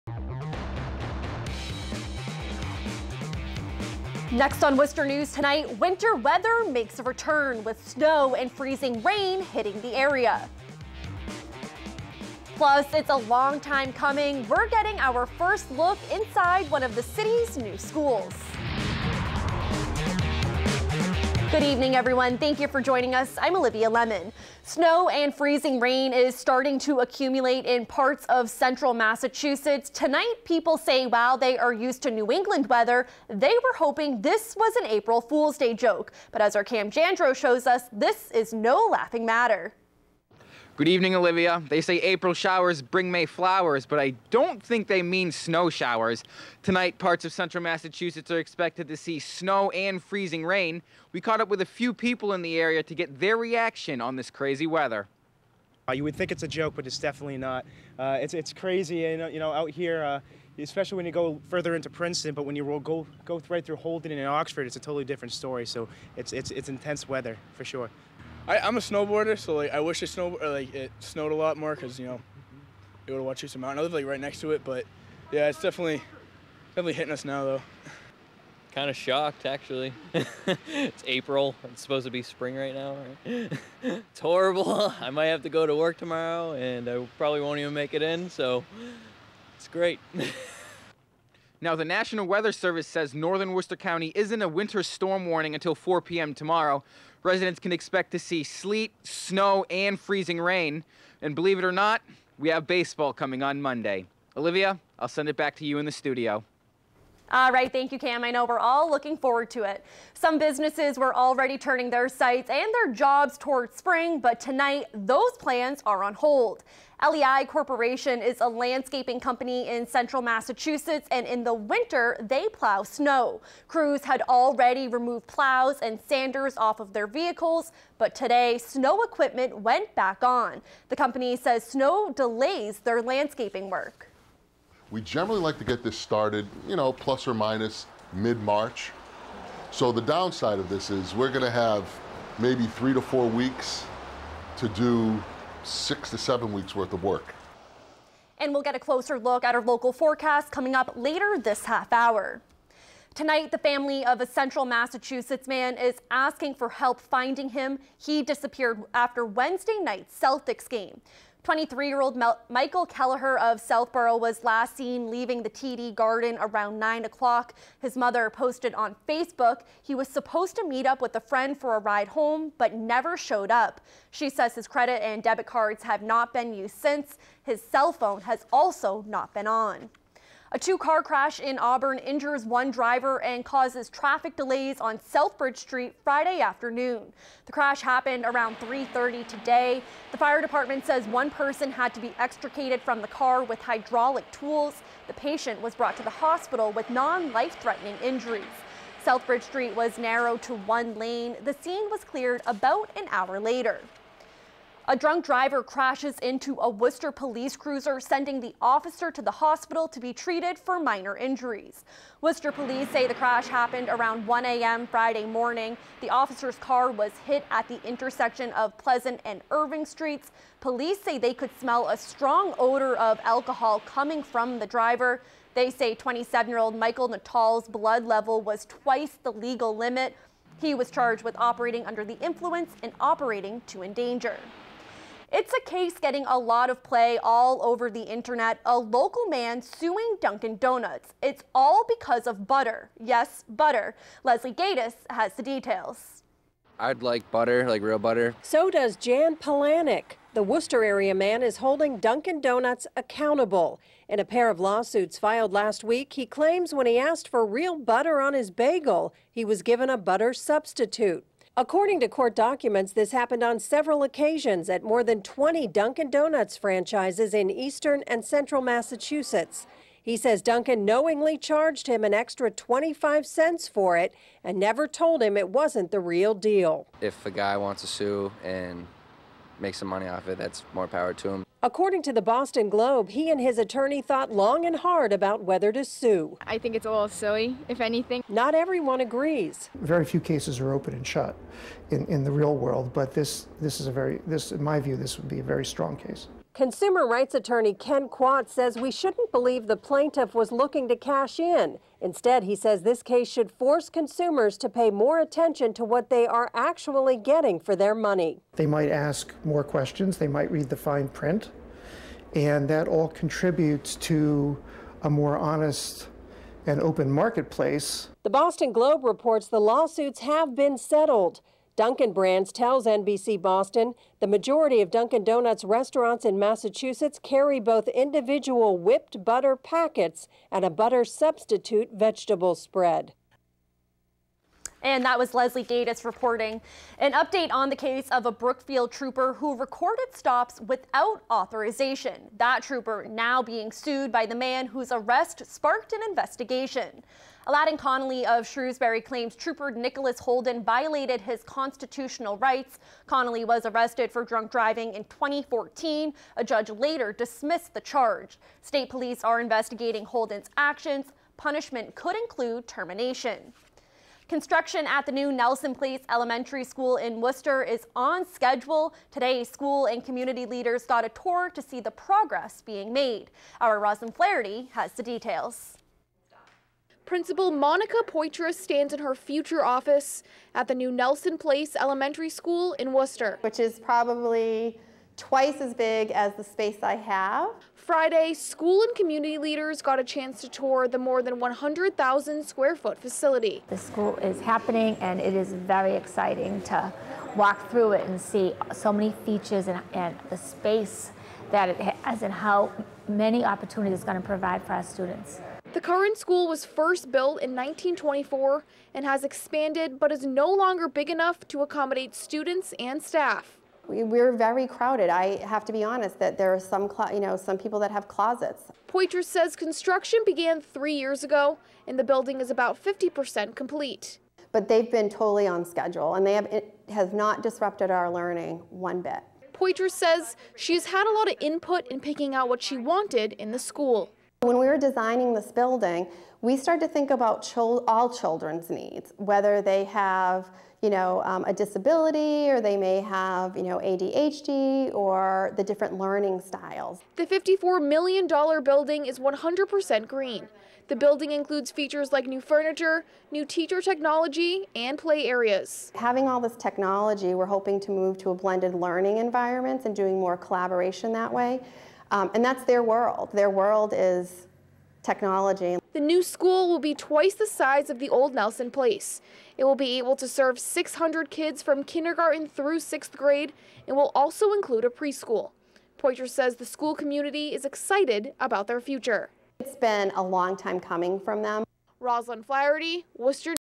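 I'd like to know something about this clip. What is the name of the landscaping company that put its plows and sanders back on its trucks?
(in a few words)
LEI Corporation.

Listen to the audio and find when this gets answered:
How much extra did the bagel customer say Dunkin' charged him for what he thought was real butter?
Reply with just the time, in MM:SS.
04:32.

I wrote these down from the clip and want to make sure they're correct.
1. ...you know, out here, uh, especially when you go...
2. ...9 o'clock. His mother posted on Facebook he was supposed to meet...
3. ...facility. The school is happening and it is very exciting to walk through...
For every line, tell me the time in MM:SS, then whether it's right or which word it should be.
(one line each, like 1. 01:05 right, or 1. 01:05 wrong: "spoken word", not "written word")
1. 00:59 right
2. 02:46 right
3. 06:32 right.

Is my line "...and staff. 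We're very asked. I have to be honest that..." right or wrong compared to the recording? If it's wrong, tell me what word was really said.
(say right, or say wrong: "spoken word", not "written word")
wrong: "crowded", not "asked".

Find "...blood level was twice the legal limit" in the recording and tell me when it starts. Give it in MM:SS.
03:47.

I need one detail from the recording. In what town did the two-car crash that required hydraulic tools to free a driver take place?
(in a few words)
Auburn.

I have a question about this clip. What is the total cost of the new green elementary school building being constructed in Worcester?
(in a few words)
$54 million.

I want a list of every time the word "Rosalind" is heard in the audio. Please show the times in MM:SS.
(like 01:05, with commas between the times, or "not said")
06:13, 08:01.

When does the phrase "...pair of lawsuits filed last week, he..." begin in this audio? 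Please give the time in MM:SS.
04:14.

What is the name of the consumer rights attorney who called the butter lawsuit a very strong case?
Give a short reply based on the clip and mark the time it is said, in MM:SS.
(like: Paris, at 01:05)
Ken Quat, at 04:57.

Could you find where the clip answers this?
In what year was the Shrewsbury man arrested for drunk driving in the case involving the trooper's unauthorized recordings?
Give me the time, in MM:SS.
05:55.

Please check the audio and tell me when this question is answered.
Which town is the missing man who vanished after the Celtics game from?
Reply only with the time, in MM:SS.
02:43.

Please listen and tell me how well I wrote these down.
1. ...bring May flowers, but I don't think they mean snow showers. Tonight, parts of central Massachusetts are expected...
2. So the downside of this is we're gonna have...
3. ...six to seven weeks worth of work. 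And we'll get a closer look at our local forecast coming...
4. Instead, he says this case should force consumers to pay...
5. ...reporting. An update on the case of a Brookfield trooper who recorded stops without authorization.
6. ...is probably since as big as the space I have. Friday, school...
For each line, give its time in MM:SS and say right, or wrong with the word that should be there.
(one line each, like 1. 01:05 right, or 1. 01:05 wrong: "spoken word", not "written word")
1. 00:42 right
2. 02:19 right
3. 02:25 right
4. 05:02 right
5. 05:36 right
6. 06:23 wrong: "twice", not "since".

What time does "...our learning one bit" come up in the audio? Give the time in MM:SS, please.
07:07.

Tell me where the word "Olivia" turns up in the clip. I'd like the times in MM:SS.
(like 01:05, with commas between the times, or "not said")
00:23, 00:41, 01:44.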